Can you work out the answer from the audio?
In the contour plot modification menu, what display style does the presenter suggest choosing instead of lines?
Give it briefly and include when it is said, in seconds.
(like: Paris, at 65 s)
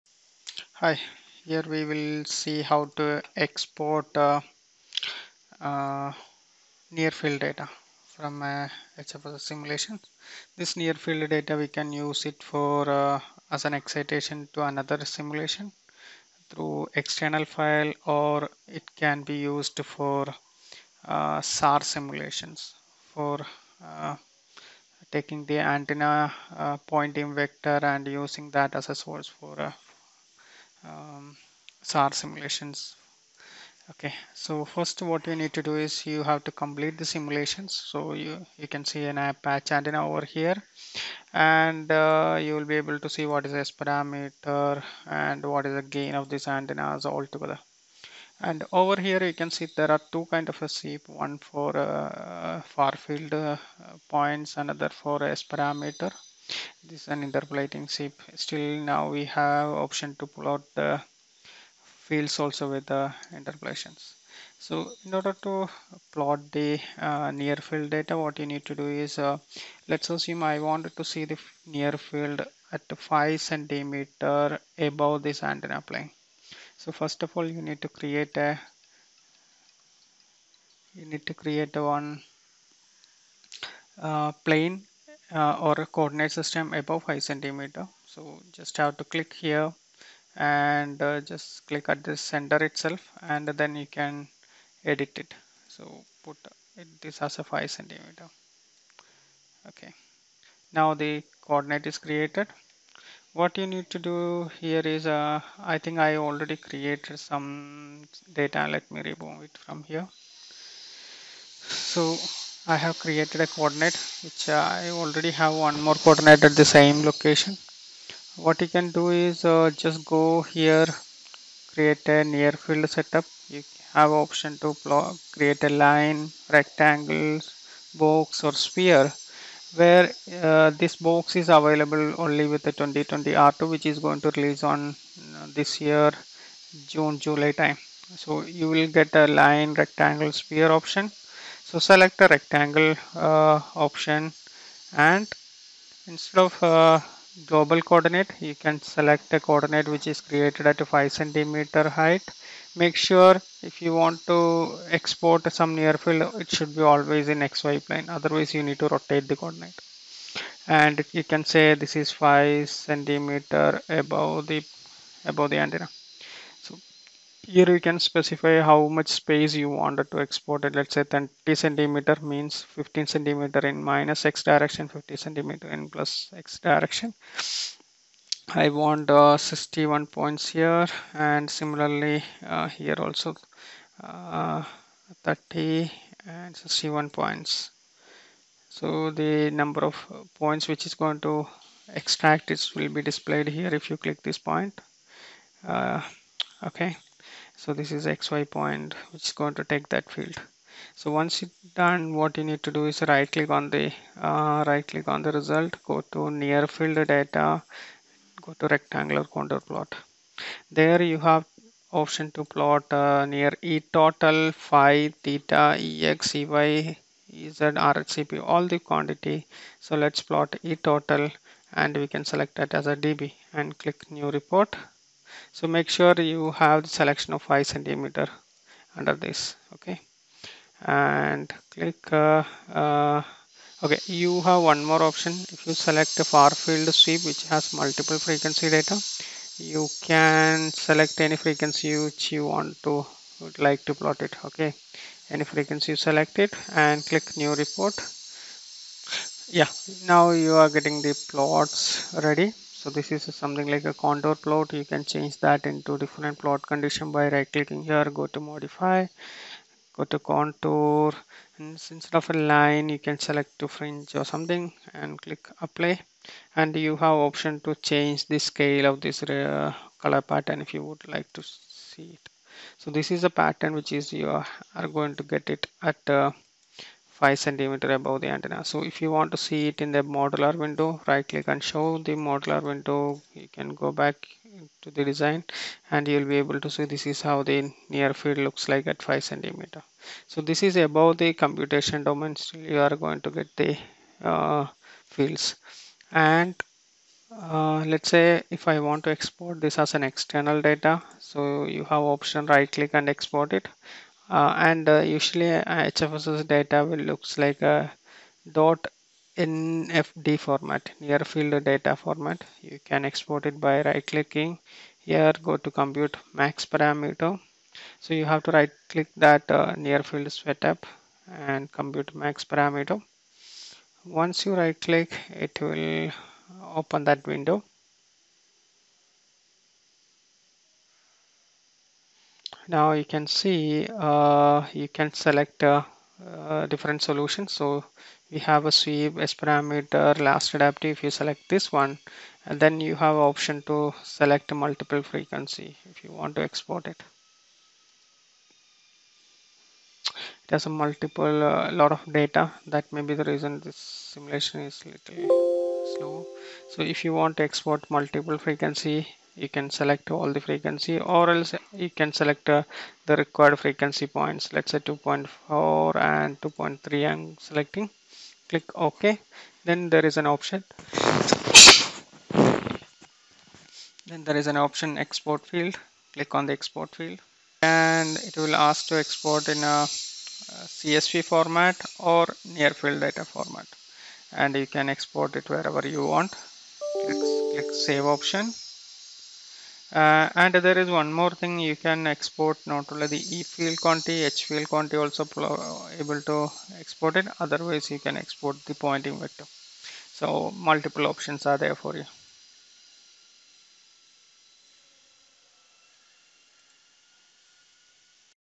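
fringe, at 263 s.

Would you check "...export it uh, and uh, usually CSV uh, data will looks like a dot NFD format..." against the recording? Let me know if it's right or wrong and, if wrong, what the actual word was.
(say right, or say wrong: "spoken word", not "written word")
wrong: "HFSS", not "CSV".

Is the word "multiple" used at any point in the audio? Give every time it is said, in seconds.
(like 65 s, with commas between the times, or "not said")
237 s, 344 s, 350 s, 357 s, 400 s.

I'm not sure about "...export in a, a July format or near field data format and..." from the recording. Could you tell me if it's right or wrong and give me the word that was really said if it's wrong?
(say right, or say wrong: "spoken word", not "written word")
wrong: "CSV", not "July".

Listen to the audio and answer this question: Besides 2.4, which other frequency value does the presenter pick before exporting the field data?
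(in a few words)
2.3.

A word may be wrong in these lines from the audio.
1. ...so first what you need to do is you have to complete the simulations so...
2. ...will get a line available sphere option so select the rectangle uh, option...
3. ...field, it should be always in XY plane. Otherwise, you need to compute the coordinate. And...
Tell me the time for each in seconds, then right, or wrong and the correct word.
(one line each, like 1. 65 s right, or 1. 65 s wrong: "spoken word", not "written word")
1. 34 s right
2. 138 s wrong: "rectangle", not "available"
3. 155 s wrong: "rotate", not "compute".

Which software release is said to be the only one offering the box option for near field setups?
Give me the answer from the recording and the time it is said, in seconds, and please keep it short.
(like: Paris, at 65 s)
2020 R2, at 132 s.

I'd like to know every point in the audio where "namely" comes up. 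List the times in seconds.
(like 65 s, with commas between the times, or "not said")
not said.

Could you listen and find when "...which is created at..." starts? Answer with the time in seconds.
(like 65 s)
149 s.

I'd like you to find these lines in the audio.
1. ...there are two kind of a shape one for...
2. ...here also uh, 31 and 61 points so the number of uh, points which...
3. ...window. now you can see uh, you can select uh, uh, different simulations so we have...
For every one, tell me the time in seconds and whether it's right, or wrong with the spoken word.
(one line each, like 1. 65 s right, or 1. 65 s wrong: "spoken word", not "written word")
1. 49 s right
2. 182 s wrong: "30", not "31"
3. 327 s wrong: "solutions", not "simulations".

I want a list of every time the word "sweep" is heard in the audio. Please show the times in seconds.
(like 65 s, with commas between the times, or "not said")
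236 s, 338 s.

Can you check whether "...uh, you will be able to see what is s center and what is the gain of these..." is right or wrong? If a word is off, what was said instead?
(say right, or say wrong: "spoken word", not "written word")
wrong: "parameter", not "center".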